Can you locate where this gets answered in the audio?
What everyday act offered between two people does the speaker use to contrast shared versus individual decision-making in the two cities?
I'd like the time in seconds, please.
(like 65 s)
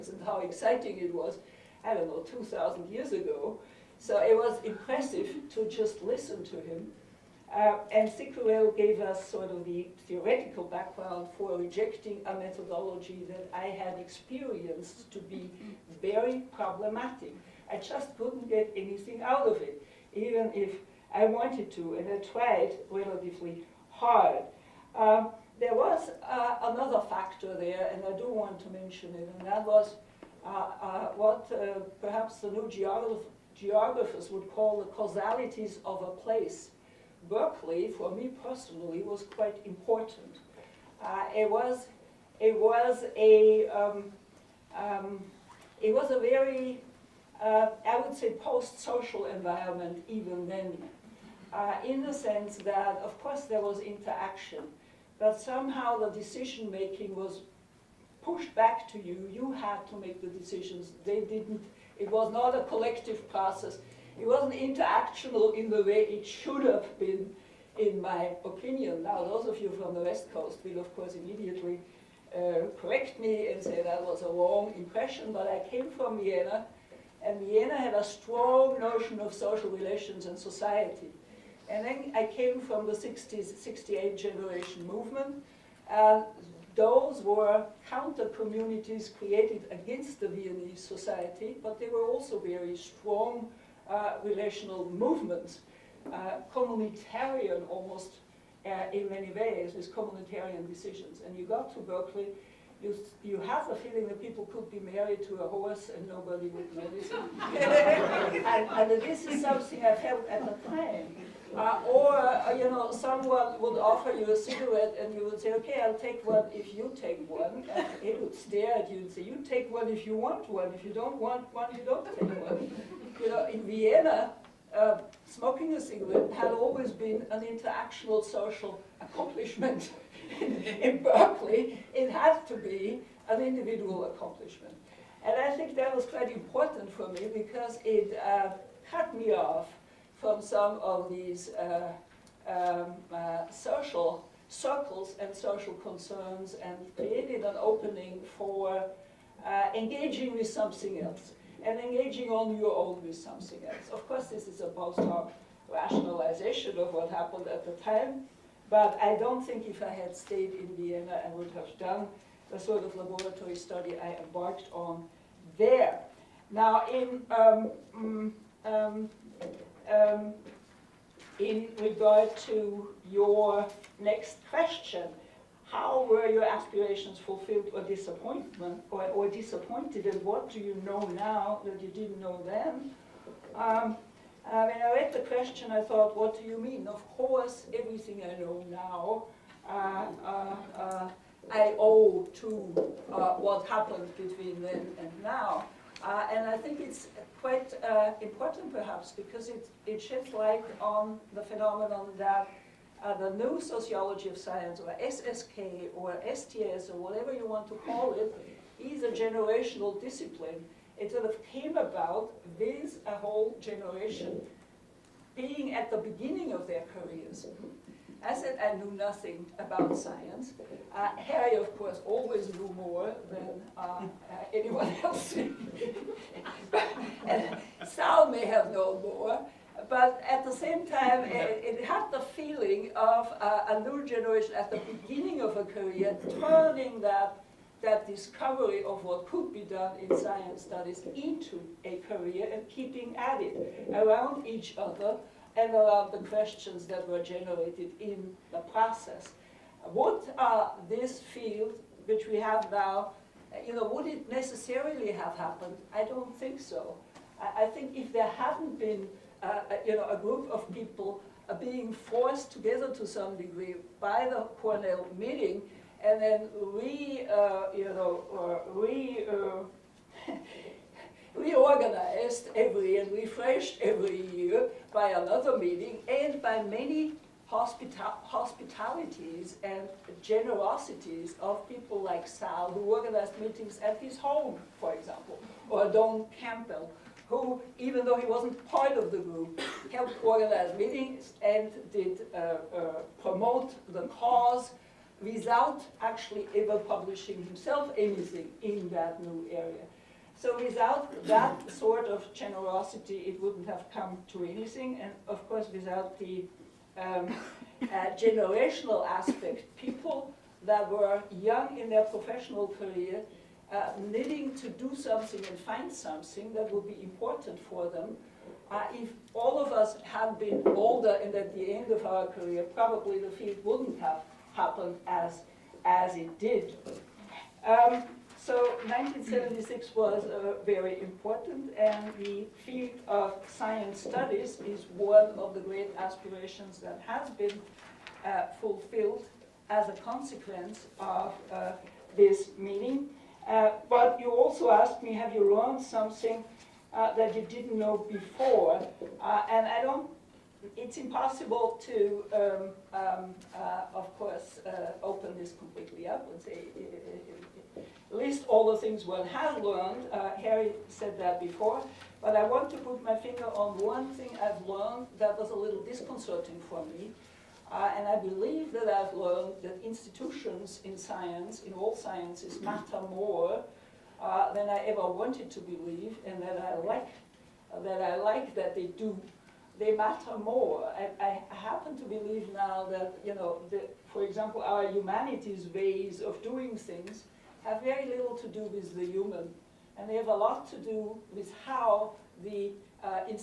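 125 s.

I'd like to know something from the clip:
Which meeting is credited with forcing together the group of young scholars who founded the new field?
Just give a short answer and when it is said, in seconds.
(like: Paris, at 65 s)
Cornell meeting, at 264 s.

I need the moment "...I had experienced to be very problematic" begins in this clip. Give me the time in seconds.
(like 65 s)
13 s.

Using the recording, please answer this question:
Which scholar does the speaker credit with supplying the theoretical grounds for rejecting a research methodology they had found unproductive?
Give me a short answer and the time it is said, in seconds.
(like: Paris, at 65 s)
Cicourel, at 8 s.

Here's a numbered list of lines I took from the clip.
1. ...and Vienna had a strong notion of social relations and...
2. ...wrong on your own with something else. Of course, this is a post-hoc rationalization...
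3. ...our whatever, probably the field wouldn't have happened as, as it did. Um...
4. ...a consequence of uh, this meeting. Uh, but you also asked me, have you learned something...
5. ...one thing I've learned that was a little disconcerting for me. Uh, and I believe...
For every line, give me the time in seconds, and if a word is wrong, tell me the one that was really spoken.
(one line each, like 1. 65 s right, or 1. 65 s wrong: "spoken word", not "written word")
1. 77 s right
2. 151 s wrong: "engaging", not "wrong"
3. 322 s wrong: "career", not "whatever"
4. 339 s right
5. 363 s right.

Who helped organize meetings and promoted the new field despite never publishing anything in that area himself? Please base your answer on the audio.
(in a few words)
Don Campbell.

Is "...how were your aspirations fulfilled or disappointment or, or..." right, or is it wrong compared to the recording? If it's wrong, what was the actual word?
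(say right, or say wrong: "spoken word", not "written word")
right.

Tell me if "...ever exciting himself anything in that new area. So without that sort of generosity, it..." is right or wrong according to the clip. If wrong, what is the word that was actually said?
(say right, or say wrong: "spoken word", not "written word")
wrong: "publishing", not "exciting".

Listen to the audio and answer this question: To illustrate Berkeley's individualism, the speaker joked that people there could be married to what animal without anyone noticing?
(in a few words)
A horse.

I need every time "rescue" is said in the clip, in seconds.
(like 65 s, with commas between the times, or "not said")
not said.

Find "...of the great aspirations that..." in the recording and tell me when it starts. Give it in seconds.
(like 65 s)
335 s.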